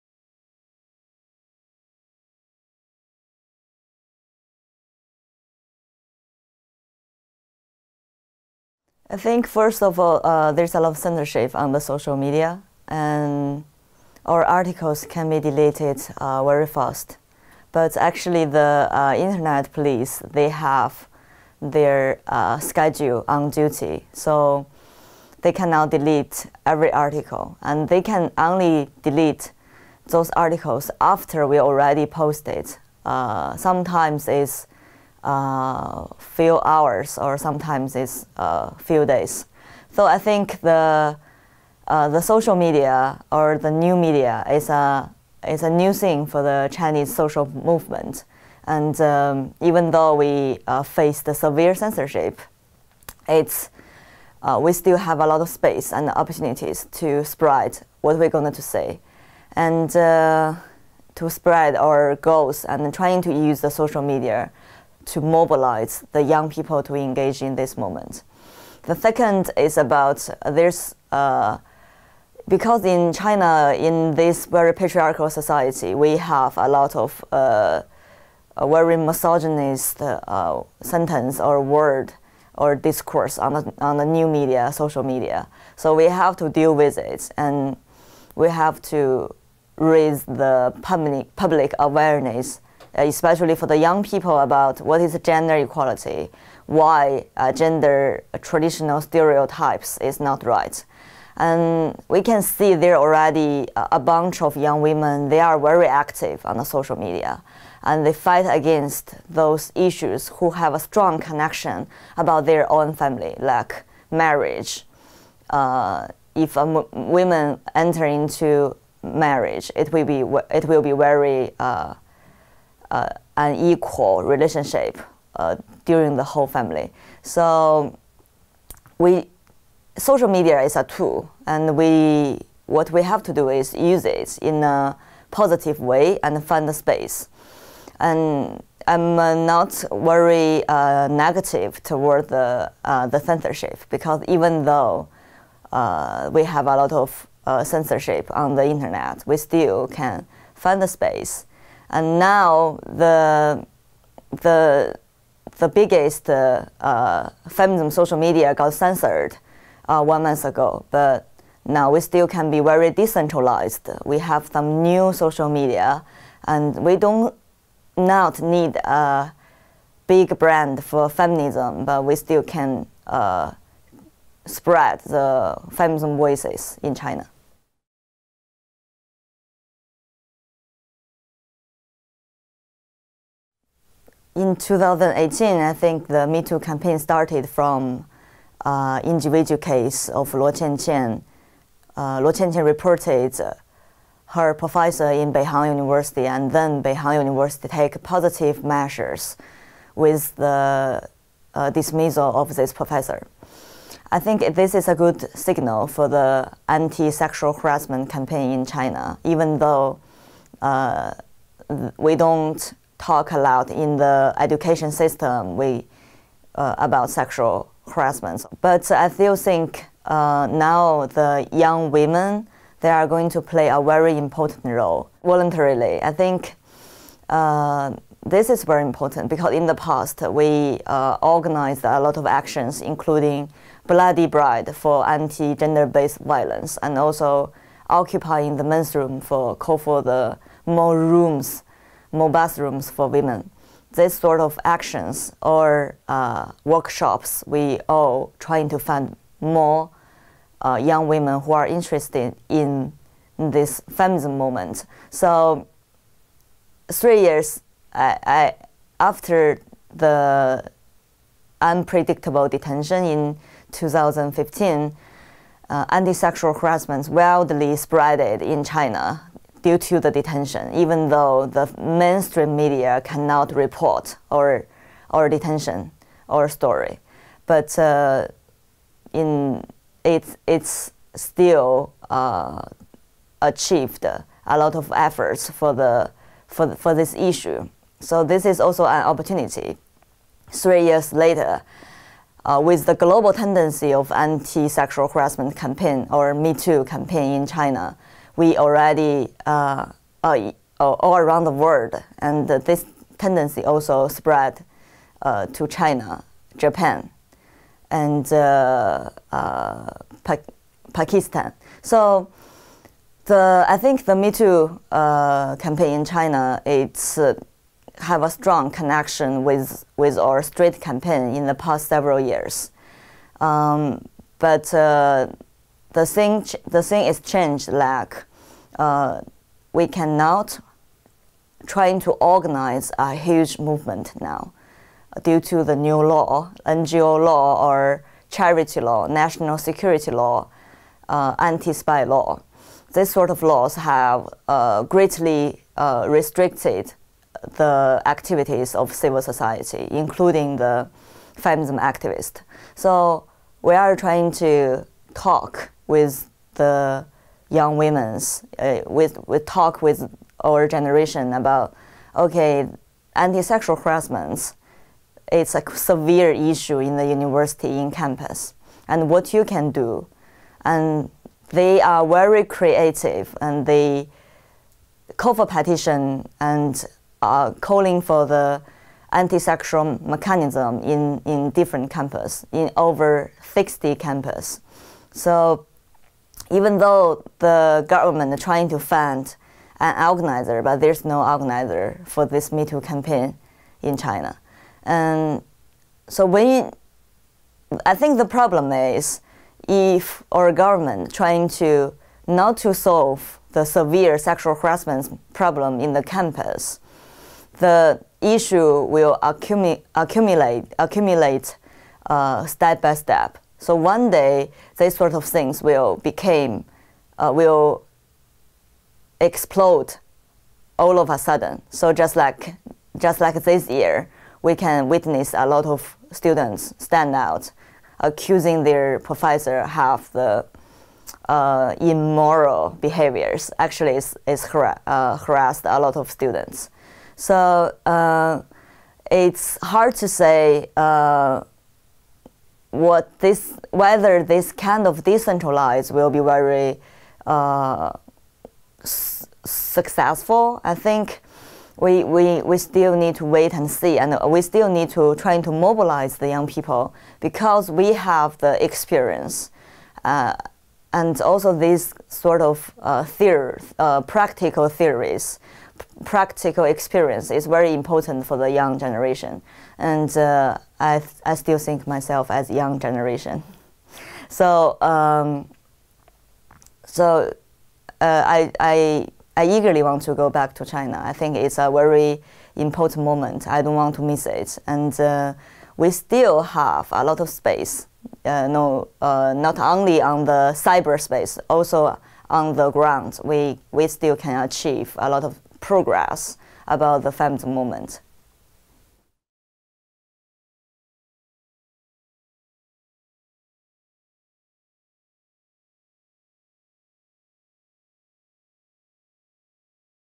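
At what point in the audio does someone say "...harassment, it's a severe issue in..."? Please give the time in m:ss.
6:03.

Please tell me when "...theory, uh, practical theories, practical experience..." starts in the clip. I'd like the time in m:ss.
7:43.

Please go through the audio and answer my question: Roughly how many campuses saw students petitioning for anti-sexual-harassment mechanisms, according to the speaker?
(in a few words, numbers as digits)
over 60.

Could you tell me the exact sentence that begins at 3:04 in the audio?
in 2018, I think the Me Too campaign started from uh, individual case of Luo Qianqian.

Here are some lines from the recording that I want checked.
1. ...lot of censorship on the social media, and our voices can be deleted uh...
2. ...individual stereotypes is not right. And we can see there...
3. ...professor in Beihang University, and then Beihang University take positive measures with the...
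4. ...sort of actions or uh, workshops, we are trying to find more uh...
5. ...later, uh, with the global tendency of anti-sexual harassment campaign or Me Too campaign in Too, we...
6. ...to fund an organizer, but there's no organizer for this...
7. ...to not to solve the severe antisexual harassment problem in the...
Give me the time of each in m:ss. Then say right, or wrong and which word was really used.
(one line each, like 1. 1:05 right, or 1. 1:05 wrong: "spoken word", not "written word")
1. 0:10 wrong: "articles", not "voices"
2. 1:38 wrong: "traditional", not "individual"
3. 3:14 right
4. 4:04 right
5. 4:51 wrong: "China", not "Too"
6. 6:28 right
7. 6:41 wrong: "sexual", not "antisexual".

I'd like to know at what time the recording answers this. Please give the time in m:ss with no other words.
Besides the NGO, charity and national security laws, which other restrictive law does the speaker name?
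5:41.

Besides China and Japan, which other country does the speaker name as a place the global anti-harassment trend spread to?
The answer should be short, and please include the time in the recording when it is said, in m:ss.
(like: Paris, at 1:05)
Pakistan, at 5:10.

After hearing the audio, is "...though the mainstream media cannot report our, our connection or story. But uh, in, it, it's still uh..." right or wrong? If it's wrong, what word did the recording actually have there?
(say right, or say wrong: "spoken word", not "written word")
wrong: "detention", not "connection".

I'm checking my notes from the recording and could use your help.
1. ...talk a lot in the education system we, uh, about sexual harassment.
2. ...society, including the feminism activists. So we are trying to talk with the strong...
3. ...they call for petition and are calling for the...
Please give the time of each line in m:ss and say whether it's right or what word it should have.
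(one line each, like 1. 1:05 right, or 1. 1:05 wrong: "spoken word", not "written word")
1. 3:33 right
2. 5:49 wrong: "young", not "strong"
3. 6:13 right.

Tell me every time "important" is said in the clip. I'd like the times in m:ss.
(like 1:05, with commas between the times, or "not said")
3:44, 3:48, 7:47, 8:02.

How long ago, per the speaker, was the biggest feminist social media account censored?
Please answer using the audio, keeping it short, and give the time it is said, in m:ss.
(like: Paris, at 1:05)
one month ago, at 2:40.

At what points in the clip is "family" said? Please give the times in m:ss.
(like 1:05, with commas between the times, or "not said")
1:52, 2:06.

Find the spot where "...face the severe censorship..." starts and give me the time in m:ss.
0:50.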